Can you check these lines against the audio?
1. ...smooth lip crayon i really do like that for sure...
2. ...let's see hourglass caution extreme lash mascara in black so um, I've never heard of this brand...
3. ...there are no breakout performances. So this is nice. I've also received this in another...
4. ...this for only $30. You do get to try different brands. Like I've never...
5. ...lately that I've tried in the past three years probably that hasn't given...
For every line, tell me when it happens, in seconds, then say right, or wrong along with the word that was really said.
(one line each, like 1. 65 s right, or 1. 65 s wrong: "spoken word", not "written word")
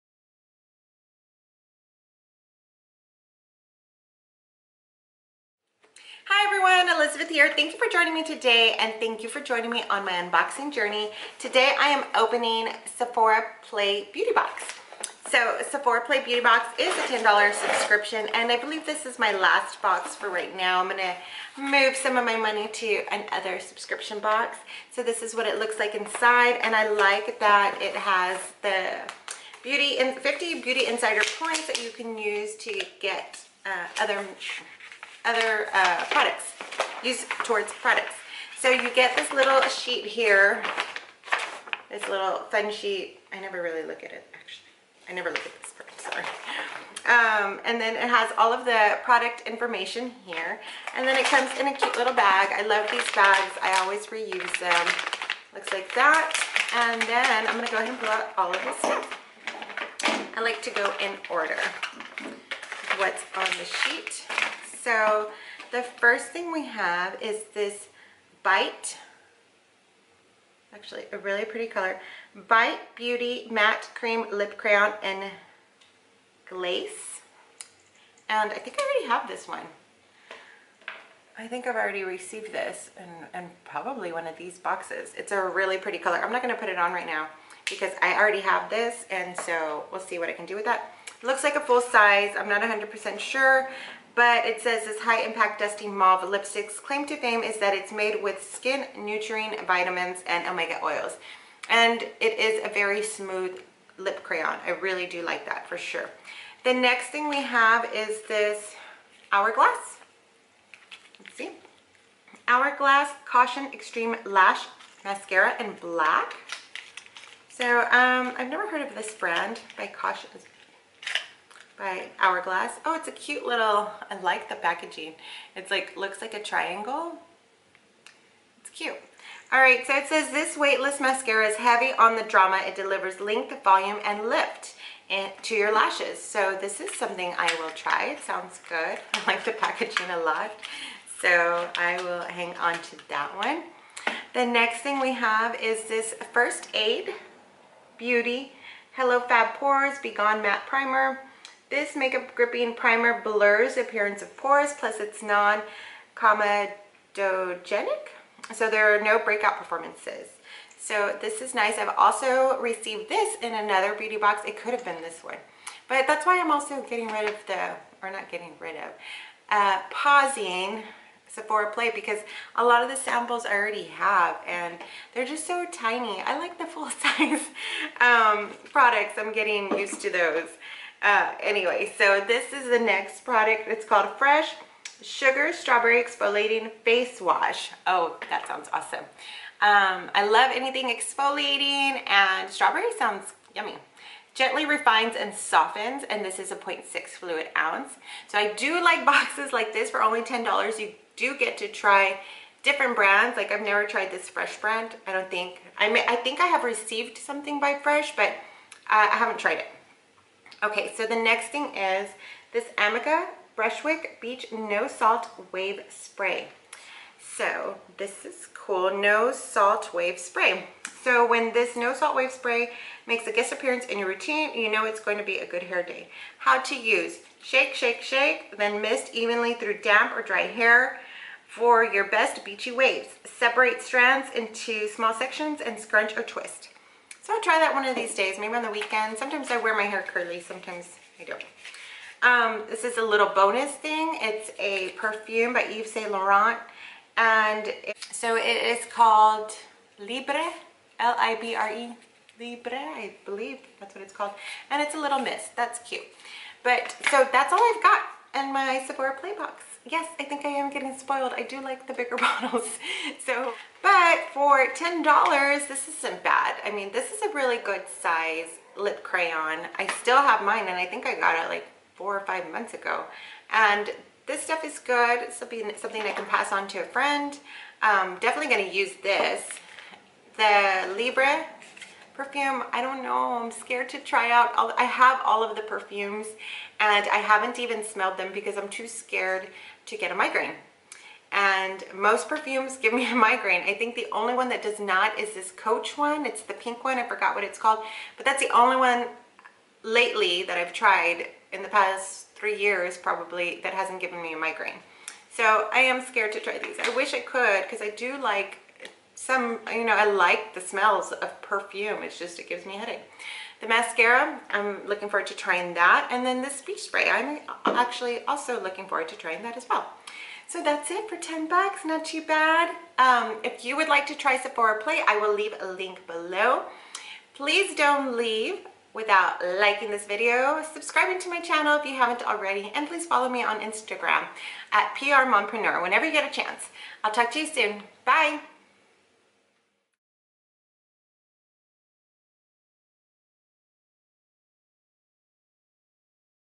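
1. 103 s right
2. 111 s right
3. 158 s right
4. 199 s wrong: "10", not "30"
5. 299 s right.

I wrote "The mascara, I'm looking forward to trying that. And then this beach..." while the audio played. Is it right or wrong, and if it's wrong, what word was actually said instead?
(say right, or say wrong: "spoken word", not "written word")
right.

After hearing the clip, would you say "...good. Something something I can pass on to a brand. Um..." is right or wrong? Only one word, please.
wrong.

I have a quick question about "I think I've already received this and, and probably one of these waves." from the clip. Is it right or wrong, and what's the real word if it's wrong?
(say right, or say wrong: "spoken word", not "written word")
wrong: "boxes", not "waves".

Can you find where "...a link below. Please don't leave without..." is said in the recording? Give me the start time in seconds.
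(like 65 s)
325 s.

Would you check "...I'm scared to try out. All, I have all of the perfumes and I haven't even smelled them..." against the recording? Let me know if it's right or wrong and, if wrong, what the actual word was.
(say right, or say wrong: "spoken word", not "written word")
right.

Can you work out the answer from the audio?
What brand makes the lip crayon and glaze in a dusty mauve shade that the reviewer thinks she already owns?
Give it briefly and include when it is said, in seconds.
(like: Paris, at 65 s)
Bite Beauty, at 72 s.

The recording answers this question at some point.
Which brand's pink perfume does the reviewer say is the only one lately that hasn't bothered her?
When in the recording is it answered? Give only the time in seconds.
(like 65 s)
295 s.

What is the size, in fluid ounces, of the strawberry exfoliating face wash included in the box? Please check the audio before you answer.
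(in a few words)
0.6 fluid ounce.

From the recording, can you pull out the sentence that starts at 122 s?
Oh, it's a cute little, I like the packaging.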